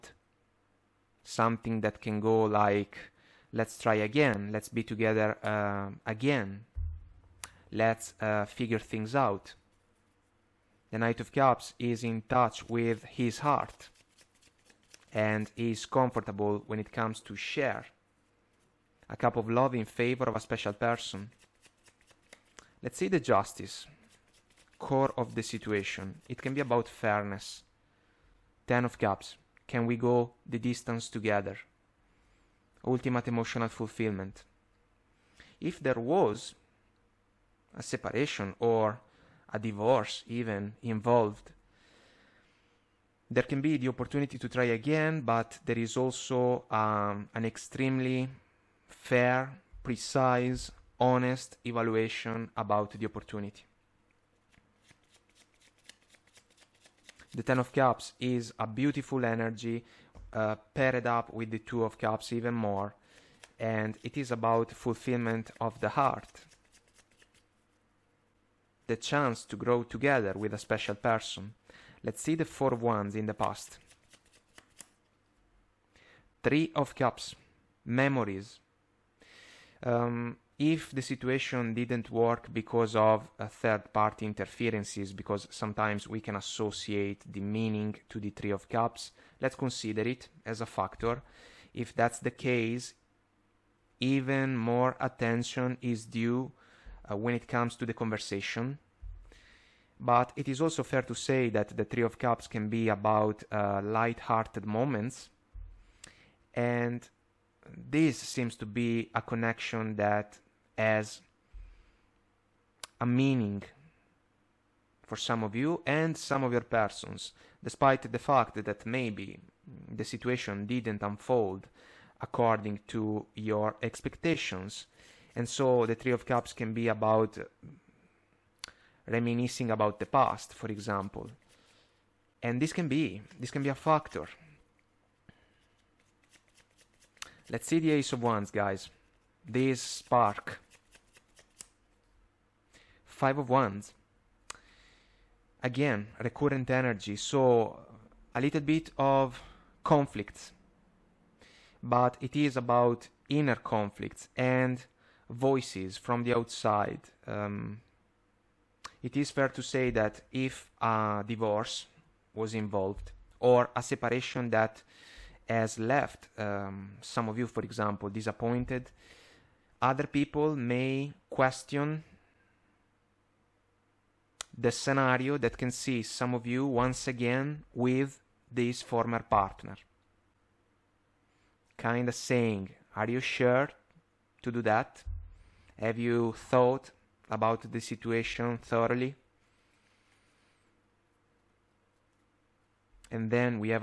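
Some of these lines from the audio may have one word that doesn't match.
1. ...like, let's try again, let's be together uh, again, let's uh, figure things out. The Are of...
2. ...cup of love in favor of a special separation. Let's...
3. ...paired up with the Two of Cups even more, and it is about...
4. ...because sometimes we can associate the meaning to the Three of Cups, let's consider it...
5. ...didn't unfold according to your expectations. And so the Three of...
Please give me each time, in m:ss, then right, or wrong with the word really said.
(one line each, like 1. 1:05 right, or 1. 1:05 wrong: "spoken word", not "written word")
1. 0:02 wrong: "Knight", not "Are"
2. 0:19 wrong: "person", not "separation"
3. 1:00 right
4. 1:25 right
5. 2:00 right.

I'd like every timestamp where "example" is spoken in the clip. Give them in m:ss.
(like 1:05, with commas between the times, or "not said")
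2:10, 2:47.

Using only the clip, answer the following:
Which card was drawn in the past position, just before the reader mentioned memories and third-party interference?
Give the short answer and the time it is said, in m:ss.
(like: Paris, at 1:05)
Four of Wands, at 1:12.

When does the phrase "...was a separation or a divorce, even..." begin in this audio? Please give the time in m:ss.
0:36.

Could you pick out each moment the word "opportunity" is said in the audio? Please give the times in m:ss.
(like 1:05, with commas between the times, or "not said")
0:43, 0:53.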